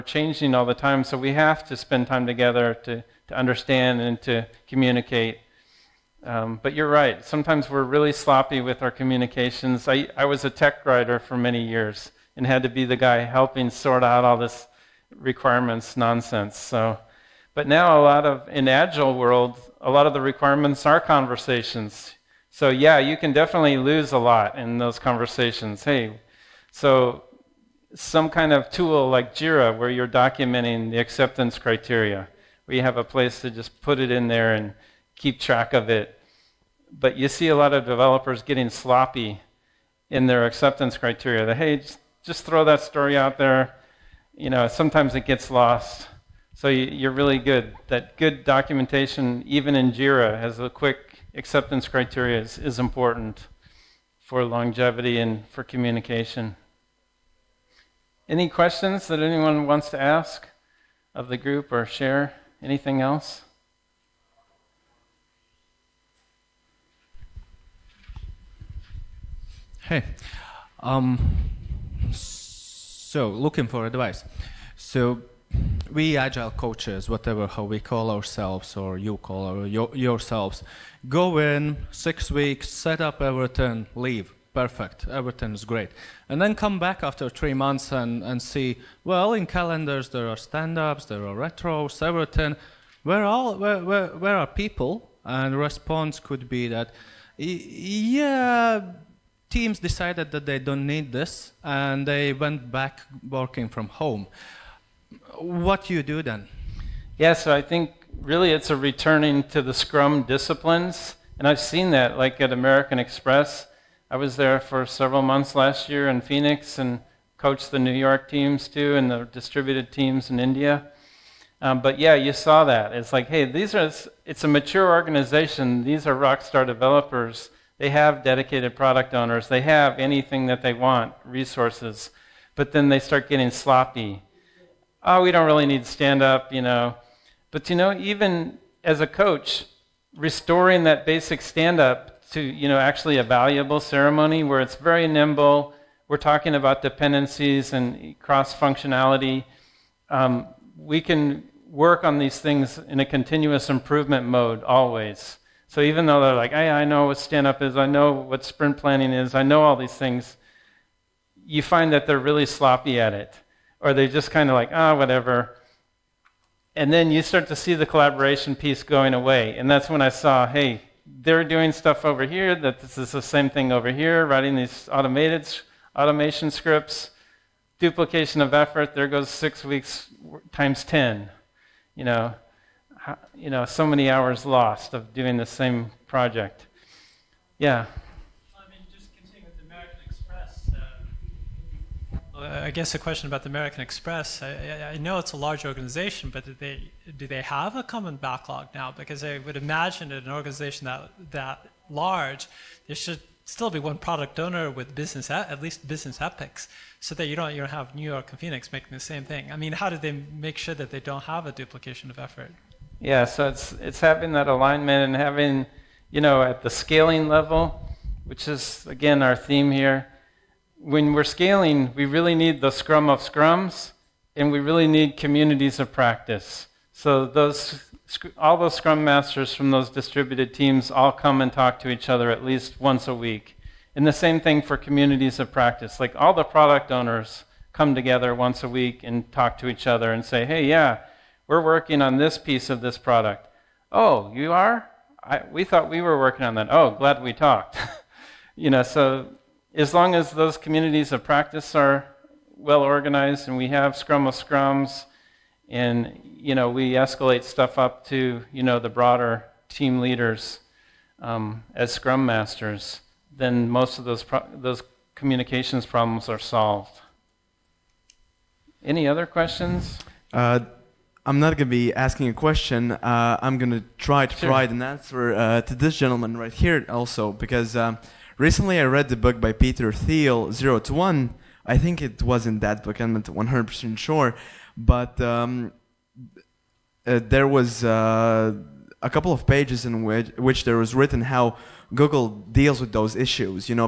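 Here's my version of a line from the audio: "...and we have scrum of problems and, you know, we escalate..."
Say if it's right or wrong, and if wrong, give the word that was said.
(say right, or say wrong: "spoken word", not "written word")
wrong: "scrums", not "problems".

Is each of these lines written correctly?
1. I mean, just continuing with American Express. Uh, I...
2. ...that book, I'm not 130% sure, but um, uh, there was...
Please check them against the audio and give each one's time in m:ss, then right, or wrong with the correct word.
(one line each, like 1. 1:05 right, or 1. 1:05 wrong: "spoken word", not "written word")
1. 3:08 right
2. 4:42 wrong: "100", not "130".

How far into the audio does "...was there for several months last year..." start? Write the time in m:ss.
1:54.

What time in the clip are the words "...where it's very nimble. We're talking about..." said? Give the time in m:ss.
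2:24.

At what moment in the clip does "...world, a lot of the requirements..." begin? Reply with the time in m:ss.
0:19.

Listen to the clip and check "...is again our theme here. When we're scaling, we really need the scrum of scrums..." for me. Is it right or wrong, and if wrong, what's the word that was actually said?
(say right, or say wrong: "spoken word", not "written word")
right.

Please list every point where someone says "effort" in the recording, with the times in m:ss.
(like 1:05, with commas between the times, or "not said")
2:58, 3:32.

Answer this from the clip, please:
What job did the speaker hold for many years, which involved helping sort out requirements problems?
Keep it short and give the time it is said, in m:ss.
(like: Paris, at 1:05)
Tech writer, at 0:10.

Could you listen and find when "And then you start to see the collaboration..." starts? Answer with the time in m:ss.
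2:46.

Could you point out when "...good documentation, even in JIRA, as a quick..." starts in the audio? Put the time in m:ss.
0:48.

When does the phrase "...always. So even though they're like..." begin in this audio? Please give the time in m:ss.
2:34.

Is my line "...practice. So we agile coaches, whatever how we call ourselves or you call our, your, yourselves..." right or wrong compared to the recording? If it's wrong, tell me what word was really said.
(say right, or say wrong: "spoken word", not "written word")
wrong: "advice", not "practice".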